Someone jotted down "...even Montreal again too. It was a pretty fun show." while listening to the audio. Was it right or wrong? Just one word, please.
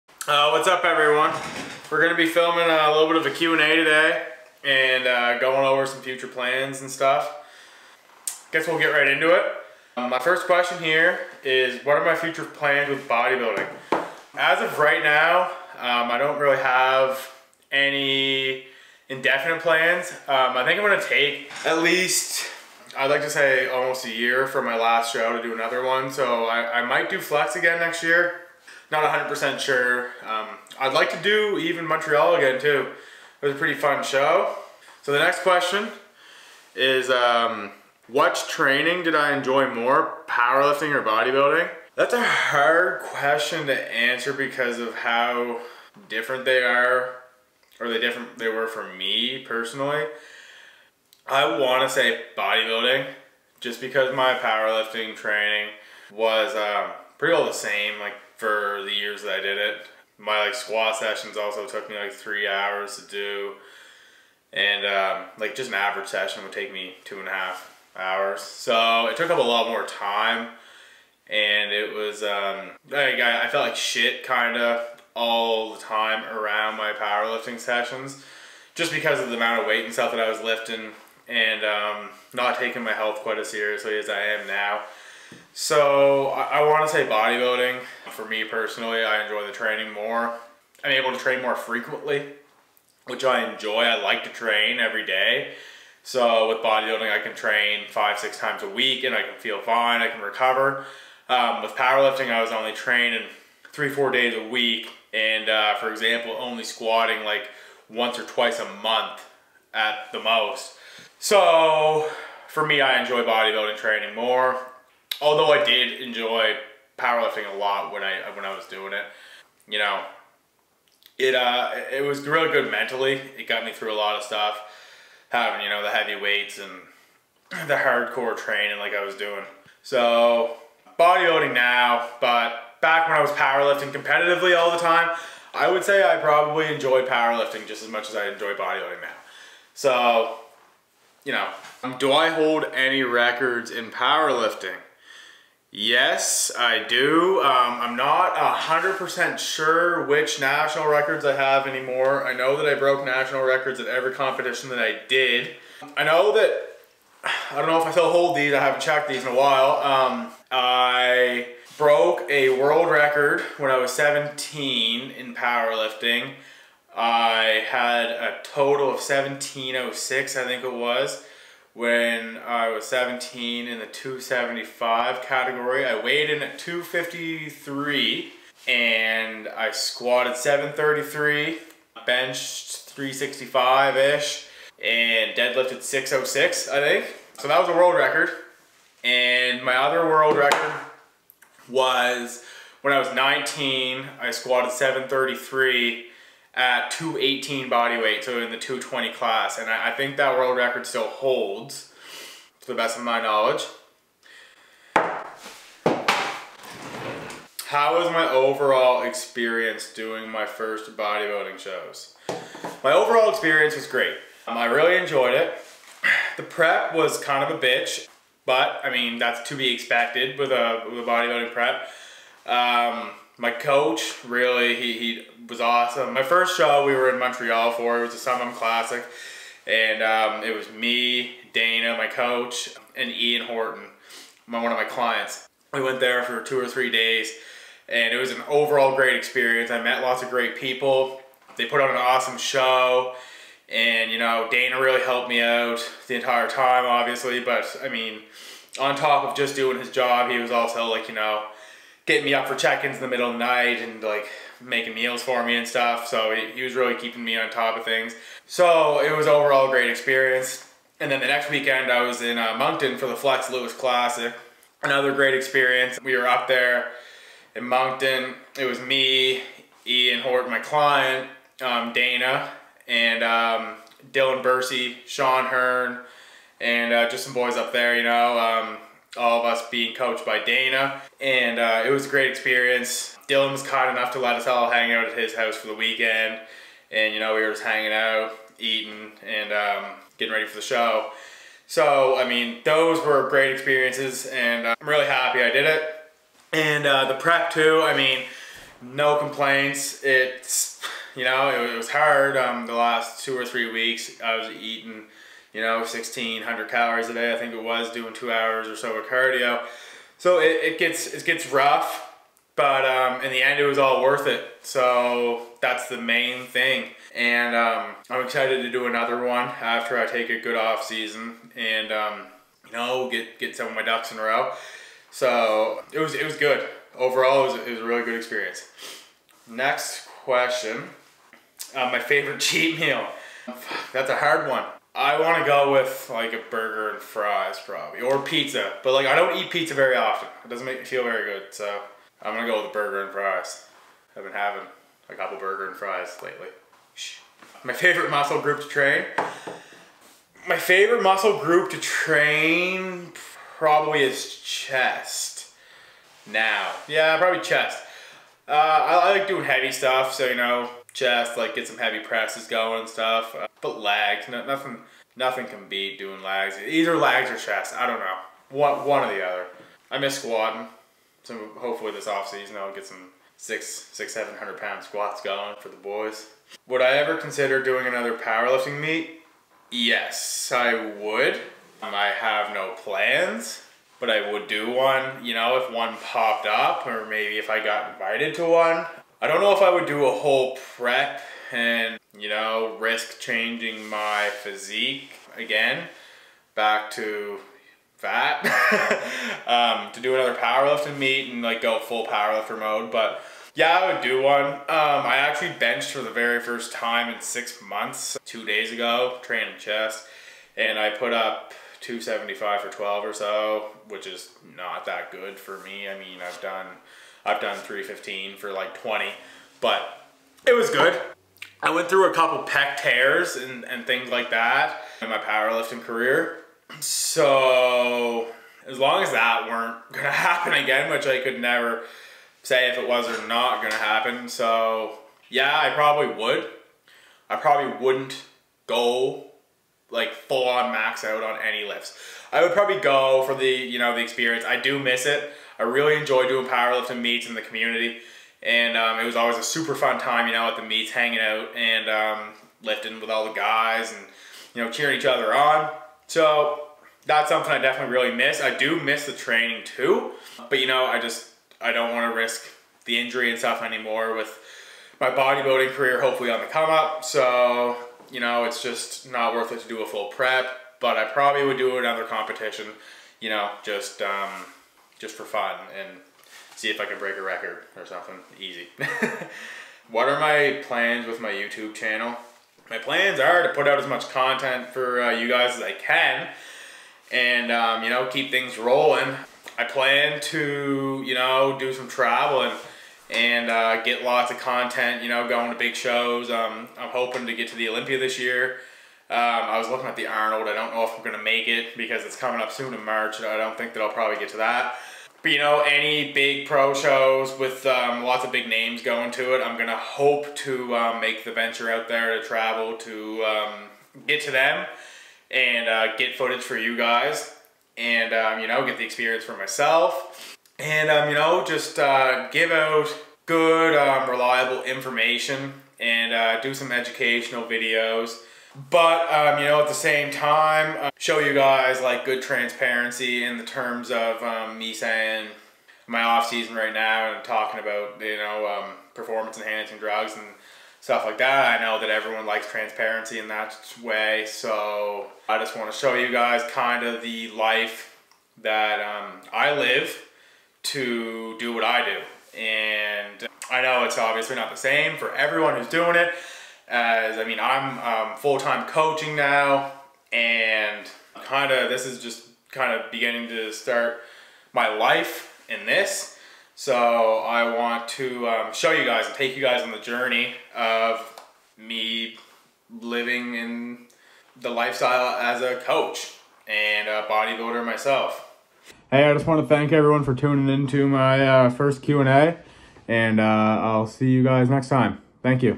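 right.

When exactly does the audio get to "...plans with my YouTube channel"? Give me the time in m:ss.
8:00.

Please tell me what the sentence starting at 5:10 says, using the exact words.
So it, it gets it gets rough, but um, in the end, it was all worth it.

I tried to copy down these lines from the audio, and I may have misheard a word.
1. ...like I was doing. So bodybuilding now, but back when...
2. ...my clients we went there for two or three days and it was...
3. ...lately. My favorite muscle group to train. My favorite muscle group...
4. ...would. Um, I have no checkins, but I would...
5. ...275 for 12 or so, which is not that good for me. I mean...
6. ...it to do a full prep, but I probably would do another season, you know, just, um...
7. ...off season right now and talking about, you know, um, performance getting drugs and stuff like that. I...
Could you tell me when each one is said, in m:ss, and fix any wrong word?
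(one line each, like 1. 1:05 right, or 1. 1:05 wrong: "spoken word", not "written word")
1. 2:08 right
2. 3:54 right
3. 5:46 right
4. 6:20 wrong: "plans", not "checkins"
5. 6:51 right
6. 7:49 wrong: "competition", not "season"
7. 8:56 wrong: "enhancing", not "getting".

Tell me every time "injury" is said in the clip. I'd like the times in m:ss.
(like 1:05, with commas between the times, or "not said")
7:42.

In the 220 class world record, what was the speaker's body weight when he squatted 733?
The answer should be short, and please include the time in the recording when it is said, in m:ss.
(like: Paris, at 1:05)
218, at 3:16.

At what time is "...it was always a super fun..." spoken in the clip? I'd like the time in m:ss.
7:28.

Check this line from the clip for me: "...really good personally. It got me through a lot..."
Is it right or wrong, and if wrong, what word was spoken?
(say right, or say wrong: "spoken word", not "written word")
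wrong: "mentally", not "personally".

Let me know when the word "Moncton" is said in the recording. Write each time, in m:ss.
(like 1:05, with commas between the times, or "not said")
4:22, 4:27.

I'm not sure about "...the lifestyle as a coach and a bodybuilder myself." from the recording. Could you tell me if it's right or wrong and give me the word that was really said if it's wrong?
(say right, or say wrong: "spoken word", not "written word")
right.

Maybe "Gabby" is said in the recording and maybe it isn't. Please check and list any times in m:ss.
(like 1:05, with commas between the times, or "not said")
not said.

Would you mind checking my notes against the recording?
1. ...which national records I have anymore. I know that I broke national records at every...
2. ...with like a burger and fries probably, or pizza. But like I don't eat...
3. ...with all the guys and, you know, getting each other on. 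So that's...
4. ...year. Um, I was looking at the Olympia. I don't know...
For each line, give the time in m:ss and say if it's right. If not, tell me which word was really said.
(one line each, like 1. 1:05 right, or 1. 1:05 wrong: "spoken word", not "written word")
1. 2:30 right
2. 5:35 right
3. 7:32 wrong: "cheering", not "getting"
4. 8:18 wrong: "Arnold", not "Olympia".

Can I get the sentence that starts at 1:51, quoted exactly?
So for me, I enjoy bodybuilding training more.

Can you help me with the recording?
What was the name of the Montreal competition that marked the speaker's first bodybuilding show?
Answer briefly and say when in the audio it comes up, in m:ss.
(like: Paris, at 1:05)
Summer classic, at 3:48.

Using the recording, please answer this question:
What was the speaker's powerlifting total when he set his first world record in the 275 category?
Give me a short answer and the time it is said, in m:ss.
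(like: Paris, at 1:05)
1706, at 2:48.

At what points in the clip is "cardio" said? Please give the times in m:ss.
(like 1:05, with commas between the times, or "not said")
5:09.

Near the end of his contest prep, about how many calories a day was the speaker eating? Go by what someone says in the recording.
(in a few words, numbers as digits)
1600.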